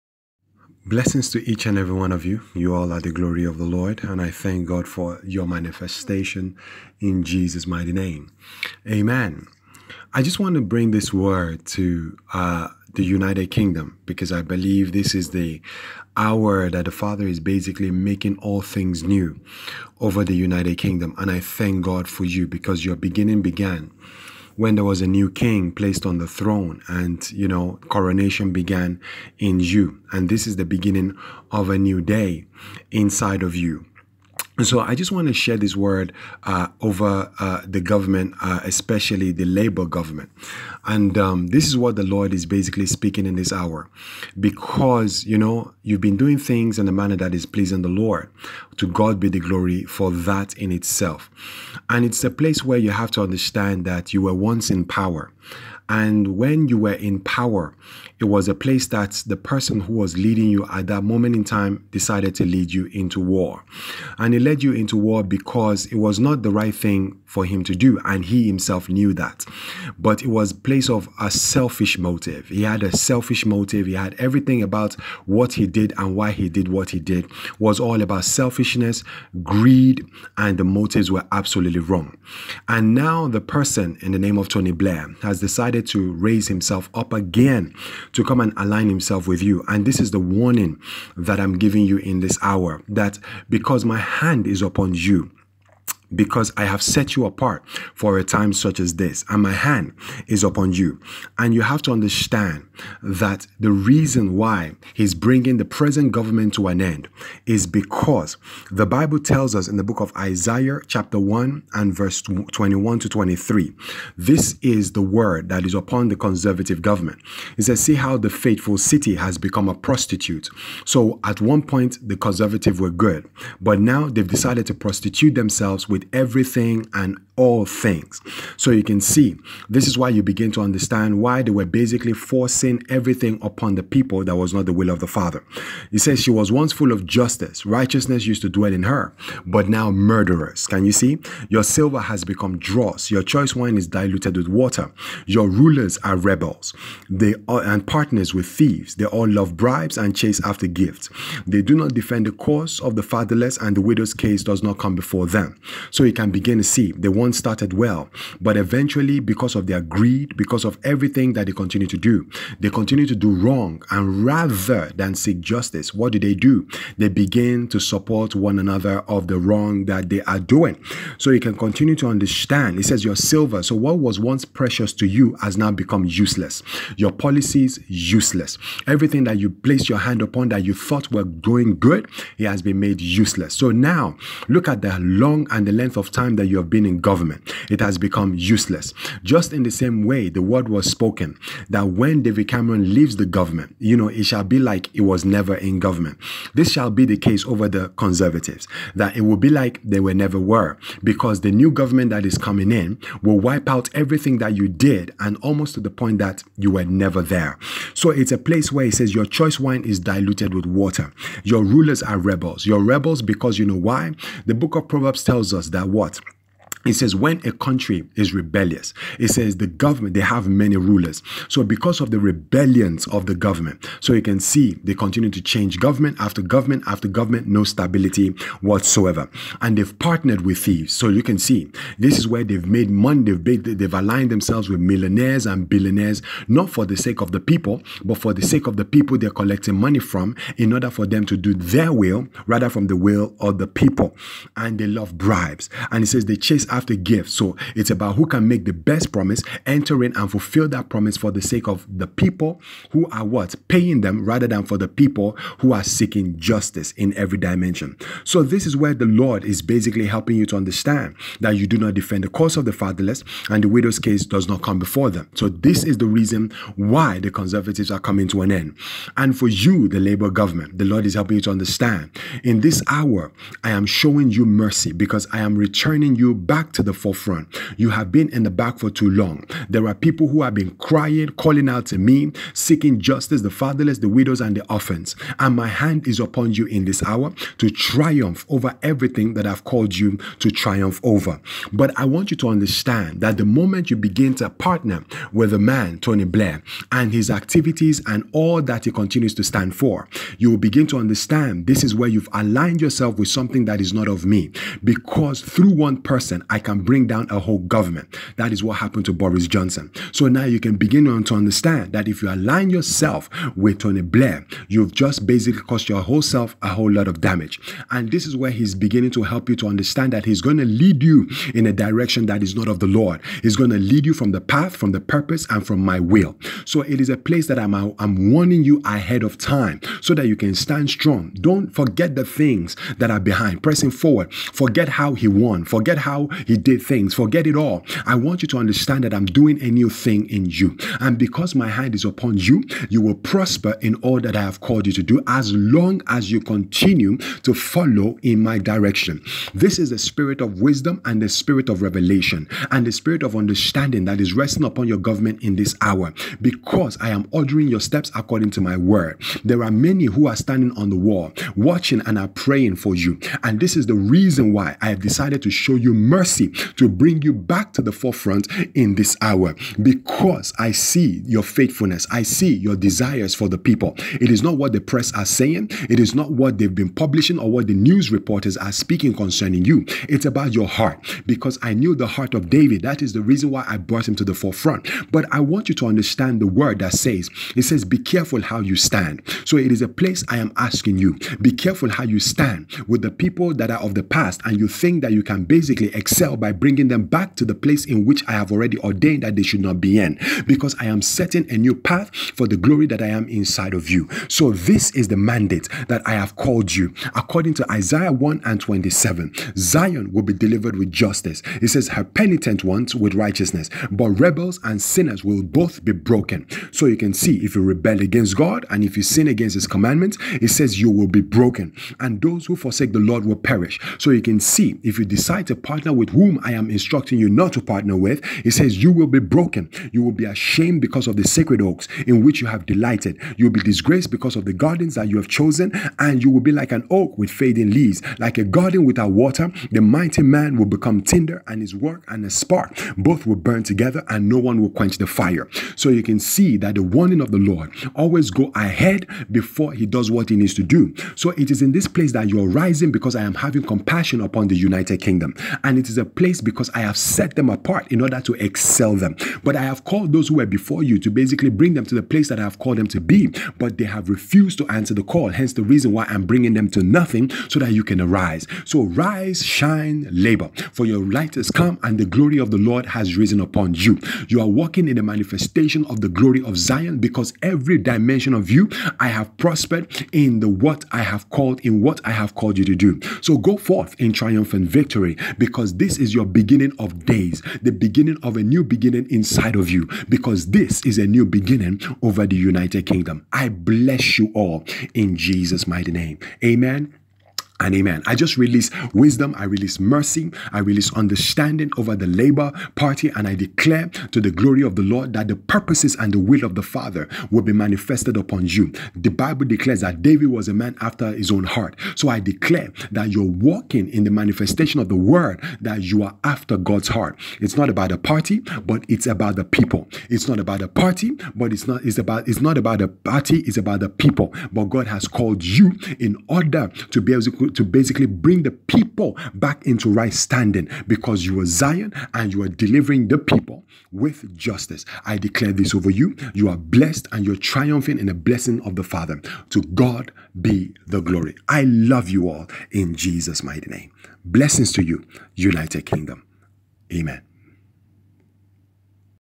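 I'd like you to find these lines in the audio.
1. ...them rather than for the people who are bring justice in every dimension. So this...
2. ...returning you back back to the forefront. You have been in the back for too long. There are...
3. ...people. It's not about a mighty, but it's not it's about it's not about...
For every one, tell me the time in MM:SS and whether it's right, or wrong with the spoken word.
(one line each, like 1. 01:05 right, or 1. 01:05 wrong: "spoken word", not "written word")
1. 04:14 wrong: "seeking", not "bring"
2. 04:35 right
3. 08:39 wrong: "party", not "mighty".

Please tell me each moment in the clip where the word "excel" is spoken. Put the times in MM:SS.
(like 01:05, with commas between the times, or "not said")
06:35, 07:38.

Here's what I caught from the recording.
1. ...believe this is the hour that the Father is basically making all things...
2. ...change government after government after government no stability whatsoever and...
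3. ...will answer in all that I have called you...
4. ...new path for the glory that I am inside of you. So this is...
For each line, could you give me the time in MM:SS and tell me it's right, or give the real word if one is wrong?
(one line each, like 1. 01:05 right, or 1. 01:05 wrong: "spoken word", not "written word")
1. 00:14 right
2. 03:45 right
3. 05:43 wrong: "prosper", not "answer"
4. 06:41 right.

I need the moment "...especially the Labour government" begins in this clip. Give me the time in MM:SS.
00:38.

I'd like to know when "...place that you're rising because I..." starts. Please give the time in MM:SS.
07:31.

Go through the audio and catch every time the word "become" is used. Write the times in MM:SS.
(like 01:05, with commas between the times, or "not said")
01:59, 02:22, 02:55, 03:08, 07:20.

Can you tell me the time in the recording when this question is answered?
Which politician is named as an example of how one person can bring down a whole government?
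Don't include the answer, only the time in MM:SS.
05:09.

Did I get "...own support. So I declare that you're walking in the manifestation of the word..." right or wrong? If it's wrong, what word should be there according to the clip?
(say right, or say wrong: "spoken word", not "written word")
wrong: "heart", not "support".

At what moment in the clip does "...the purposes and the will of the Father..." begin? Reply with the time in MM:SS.
08:25.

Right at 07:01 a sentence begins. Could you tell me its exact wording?
And those who forsake the Lord will perish.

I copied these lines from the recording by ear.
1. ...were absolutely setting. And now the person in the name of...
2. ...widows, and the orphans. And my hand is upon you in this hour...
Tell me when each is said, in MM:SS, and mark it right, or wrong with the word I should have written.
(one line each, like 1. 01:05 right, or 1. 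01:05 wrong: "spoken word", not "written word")
1. 01:21 wrong: "wrong", not "setting"
2. 04:44 right.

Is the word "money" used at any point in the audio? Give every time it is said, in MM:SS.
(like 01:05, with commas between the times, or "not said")
03:52, 03:59.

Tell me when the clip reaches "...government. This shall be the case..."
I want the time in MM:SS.
03:15.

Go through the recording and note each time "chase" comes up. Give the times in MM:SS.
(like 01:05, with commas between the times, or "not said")
02:30, 04:06.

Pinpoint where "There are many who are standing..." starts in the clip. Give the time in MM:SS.
05:59.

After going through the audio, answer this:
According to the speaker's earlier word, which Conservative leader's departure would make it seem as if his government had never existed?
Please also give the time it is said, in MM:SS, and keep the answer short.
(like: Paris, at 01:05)
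David Cameron, at 03:12.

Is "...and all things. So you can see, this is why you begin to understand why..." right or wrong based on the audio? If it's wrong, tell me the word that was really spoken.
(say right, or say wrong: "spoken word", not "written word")
right.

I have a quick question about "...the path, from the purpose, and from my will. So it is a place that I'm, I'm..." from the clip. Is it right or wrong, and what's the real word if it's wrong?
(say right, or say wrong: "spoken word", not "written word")
right.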